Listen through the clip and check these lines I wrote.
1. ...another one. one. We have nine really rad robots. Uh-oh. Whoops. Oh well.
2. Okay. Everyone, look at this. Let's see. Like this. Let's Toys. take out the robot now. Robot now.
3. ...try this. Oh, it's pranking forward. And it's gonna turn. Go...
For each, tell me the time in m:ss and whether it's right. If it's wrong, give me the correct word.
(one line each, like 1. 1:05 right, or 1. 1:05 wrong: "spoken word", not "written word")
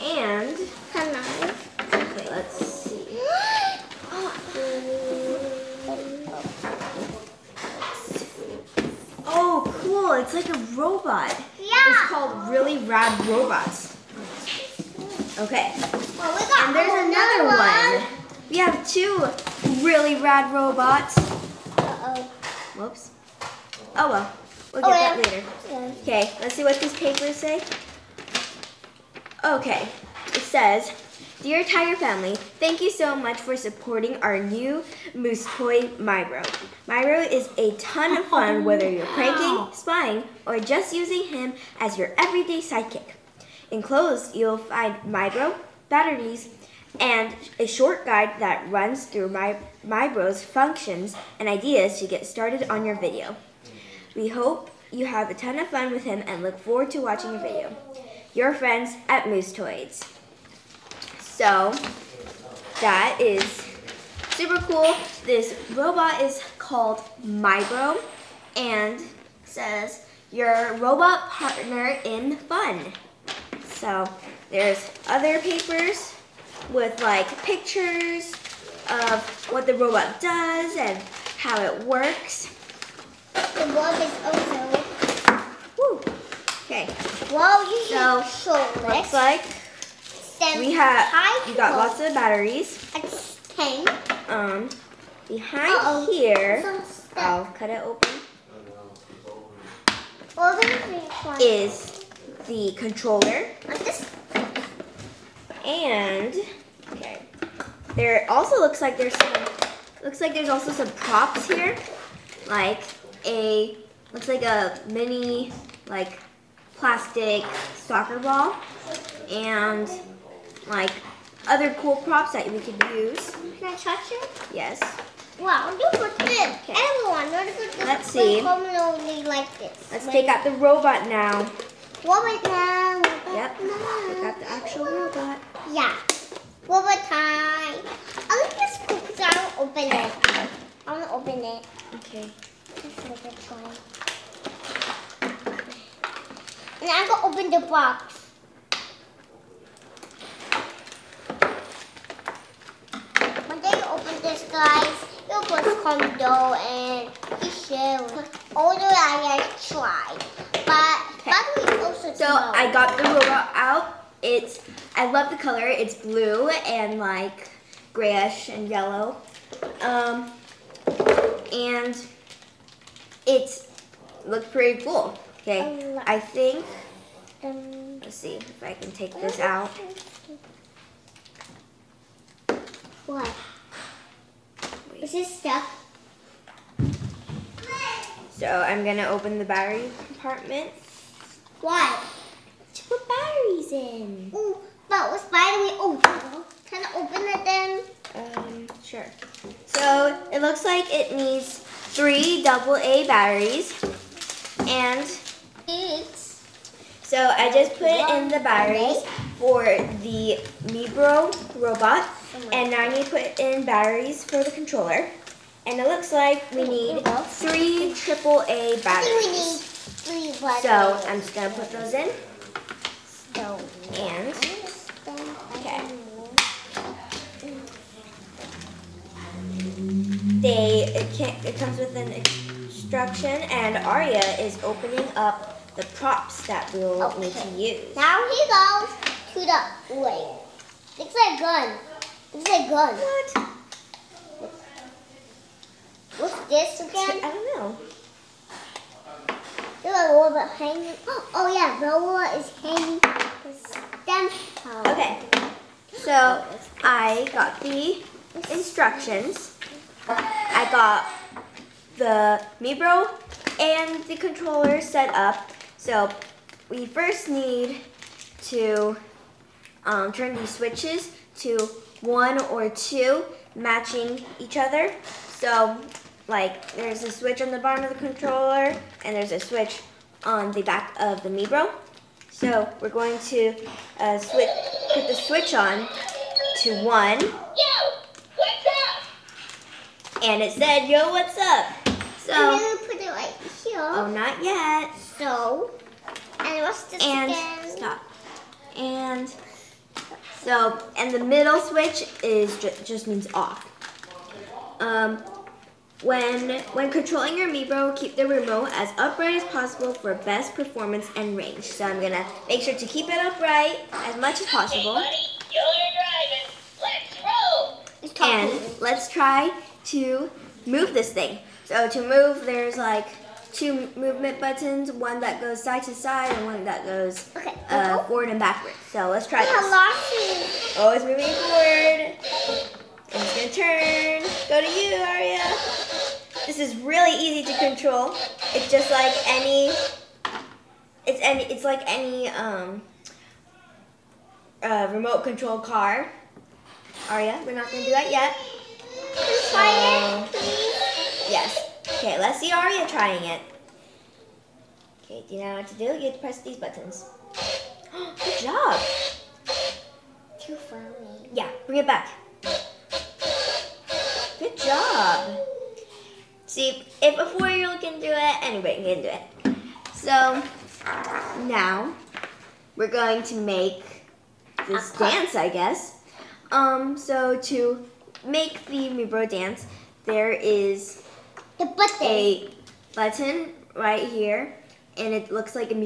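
1. 0:17 wrong: "two", not "nine"
2. 2:06 wrong: "Wait", not "Toys"
3. 5:29 wrong: "moving", not "pranking".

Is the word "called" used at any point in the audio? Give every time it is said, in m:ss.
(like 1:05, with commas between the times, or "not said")
0:12, 1:06.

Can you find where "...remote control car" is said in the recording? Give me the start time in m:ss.
5:44.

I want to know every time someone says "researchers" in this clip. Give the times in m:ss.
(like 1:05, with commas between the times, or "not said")
not said.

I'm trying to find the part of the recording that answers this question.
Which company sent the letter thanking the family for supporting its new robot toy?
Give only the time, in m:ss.
0:59.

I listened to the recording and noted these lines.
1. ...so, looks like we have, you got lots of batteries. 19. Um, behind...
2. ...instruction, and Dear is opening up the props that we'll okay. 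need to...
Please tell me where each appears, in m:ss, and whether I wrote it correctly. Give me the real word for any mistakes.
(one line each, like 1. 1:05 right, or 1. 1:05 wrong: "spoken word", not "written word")
1. 1:28 wrong: "10", not "19"
2. 3:52 wrong: "Aria", not "Dear".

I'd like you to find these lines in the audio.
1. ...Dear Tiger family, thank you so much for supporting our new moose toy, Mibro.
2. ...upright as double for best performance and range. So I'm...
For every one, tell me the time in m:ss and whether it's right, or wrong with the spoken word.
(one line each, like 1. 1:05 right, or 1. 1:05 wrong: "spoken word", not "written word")
1. 0:31 right
2. 5:08 wrong: "possible", not "double".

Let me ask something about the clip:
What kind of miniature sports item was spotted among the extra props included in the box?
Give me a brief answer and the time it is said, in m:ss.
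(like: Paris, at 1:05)
soccer ball, at 1:57.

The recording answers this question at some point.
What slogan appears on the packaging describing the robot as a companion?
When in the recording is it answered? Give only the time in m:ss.
1:10.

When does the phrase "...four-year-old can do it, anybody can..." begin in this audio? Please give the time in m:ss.
6:07.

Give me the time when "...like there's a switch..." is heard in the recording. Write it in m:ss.
4:36.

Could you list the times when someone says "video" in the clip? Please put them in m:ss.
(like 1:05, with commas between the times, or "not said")
0:52, 0:57.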